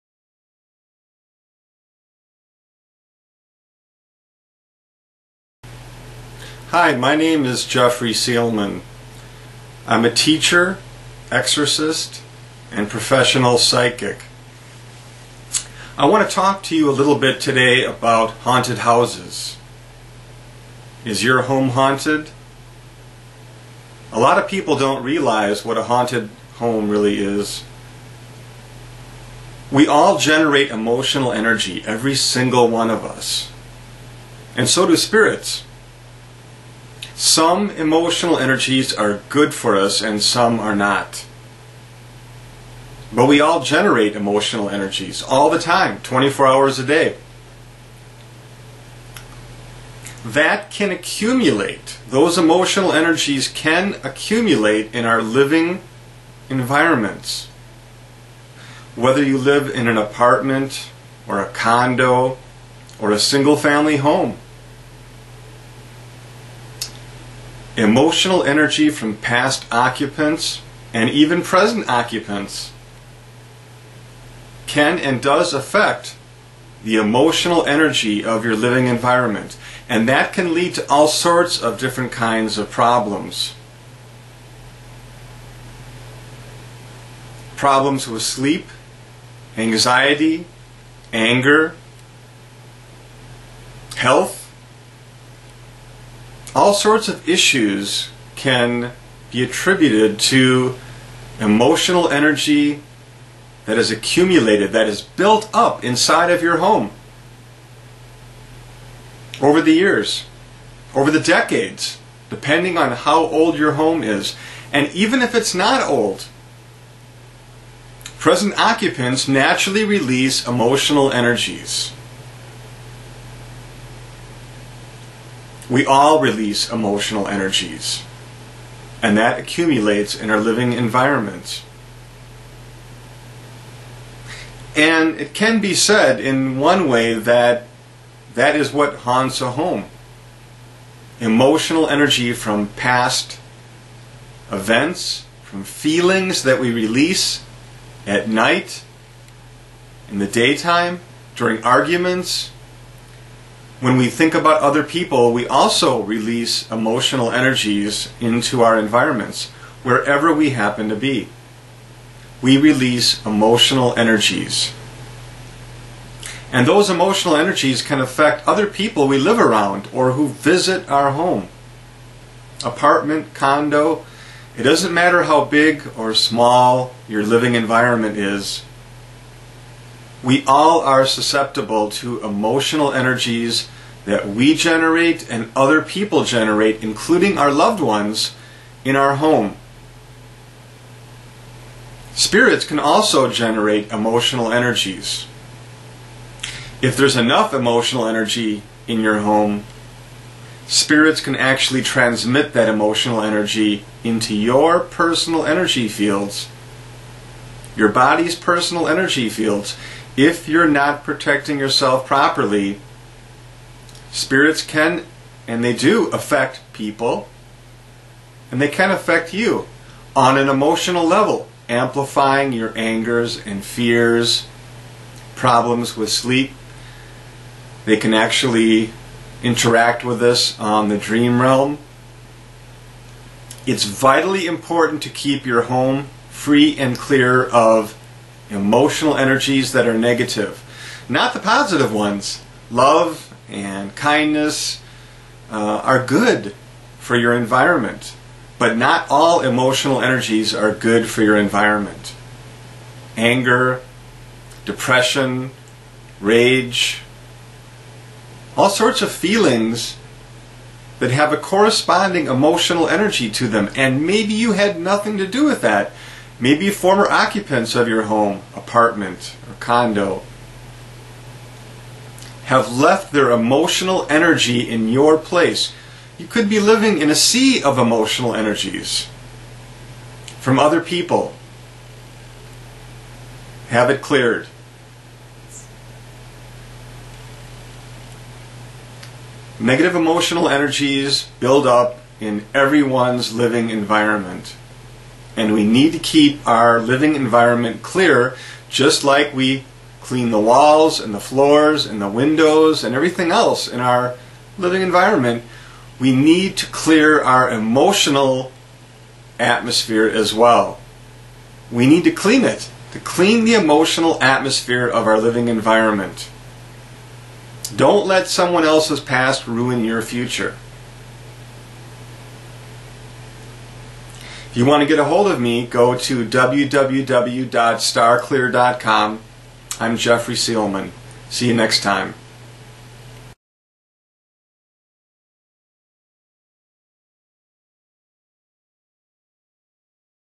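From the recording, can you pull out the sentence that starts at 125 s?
We all release emotional energies, and that accumulates in our living environment.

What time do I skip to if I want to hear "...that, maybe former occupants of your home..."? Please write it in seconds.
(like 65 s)
265 s.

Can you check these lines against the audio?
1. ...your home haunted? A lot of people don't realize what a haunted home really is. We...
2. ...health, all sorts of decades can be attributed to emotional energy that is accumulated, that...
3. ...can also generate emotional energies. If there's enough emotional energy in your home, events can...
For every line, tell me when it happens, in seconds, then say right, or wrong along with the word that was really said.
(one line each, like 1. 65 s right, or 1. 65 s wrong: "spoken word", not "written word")
1. 21 s right
2. 93 s wrong: "issues", not "decades"
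3. 192 s wrong: "spirits", not "events".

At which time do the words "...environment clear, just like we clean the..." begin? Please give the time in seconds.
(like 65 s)
297 s.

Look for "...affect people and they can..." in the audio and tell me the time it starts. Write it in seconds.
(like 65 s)
216 s.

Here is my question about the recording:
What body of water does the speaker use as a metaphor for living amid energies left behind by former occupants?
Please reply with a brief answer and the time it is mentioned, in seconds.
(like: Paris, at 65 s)
A sea, at 277 s.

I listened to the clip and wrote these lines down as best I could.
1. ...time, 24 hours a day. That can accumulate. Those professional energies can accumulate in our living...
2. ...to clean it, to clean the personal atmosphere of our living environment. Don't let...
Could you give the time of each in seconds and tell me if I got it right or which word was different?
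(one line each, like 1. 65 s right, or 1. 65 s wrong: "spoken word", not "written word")
1. 45 s wrong: "emotional", not "professional"
2. 312 s wrong: "emotional", not "personal".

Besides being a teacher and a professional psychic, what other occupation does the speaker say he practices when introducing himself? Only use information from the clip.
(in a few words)
Exorcist.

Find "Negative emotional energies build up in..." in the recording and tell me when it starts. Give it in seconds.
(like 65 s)
289 s.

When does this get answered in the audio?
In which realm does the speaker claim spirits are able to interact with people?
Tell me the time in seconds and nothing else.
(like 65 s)
230 s.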